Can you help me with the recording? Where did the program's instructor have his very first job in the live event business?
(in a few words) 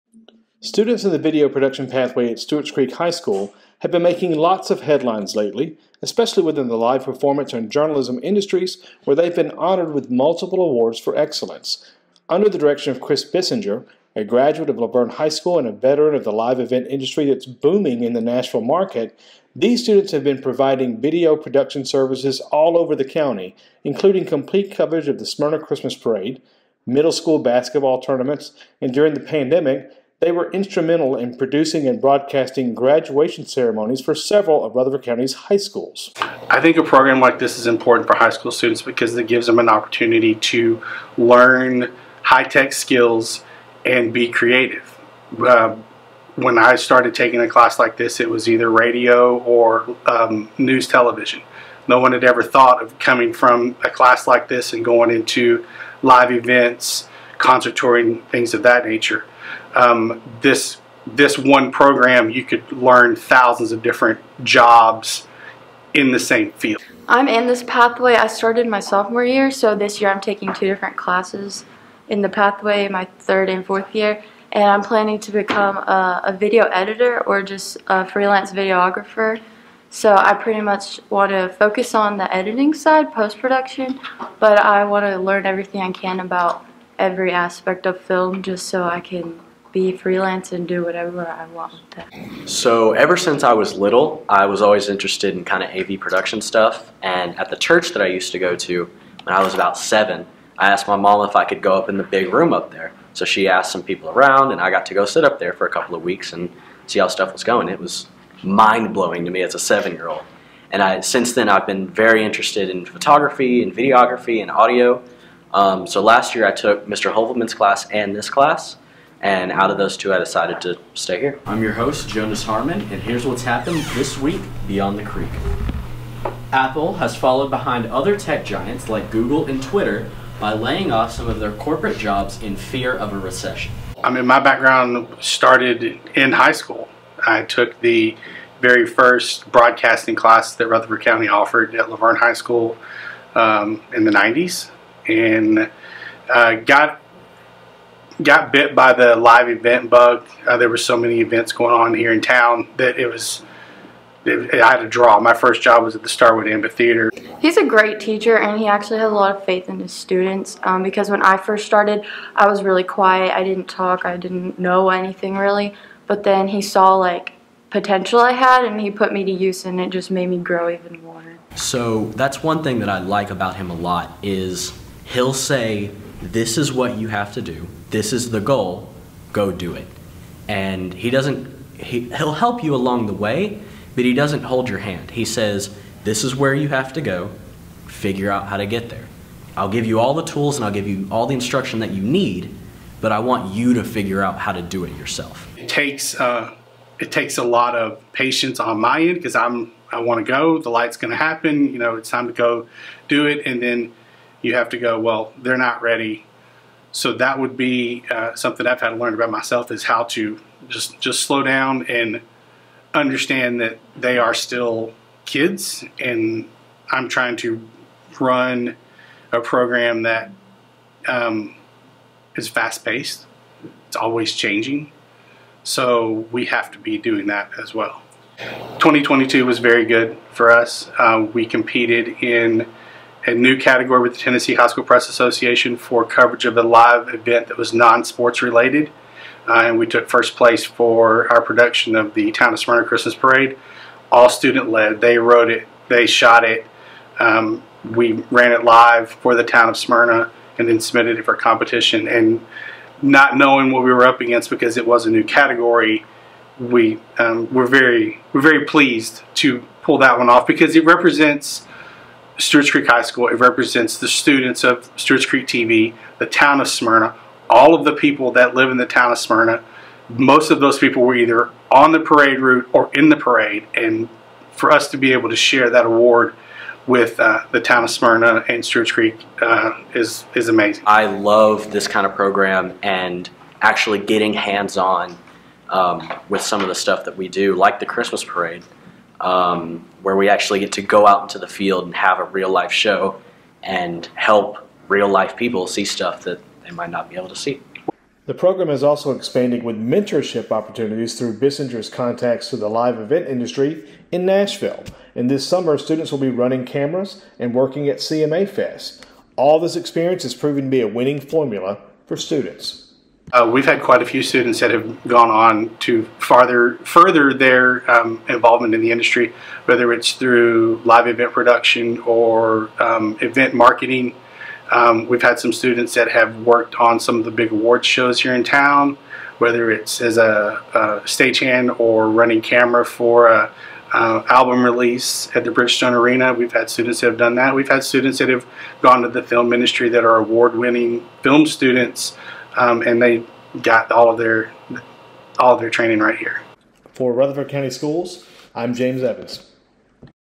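Starwood Amphitheater.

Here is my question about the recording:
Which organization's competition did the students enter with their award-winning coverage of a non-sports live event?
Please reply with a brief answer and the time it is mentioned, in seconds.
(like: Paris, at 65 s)
Tennessee High School Press Association, at 234 s.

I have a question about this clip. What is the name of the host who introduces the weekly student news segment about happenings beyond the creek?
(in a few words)
Jonas Harmon.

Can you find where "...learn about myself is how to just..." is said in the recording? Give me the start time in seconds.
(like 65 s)
208 s.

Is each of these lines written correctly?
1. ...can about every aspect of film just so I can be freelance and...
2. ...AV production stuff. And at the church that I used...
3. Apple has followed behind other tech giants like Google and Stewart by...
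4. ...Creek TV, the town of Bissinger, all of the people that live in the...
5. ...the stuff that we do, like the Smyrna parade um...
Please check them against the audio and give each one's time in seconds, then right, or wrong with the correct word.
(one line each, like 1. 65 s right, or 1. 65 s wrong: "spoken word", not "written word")
1. 85 s right
2. 95 s right
3. 126 s wrong: "Twitter", not "Stewart"
4. 265 s wrong: "Smyrna", not "Bissinger"
5. 286 s wrong: "Christmas", not "Smyrna".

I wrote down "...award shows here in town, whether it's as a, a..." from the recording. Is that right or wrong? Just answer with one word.
right.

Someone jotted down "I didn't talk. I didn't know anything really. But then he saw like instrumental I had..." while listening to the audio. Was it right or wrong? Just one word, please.
wrong.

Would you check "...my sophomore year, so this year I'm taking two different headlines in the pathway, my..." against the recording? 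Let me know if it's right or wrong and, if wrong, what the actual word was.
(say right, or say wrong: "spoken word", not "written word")
wrong: "classes", not "headlines".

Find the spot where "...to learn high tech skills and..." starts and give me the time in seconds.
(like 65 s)
40 s.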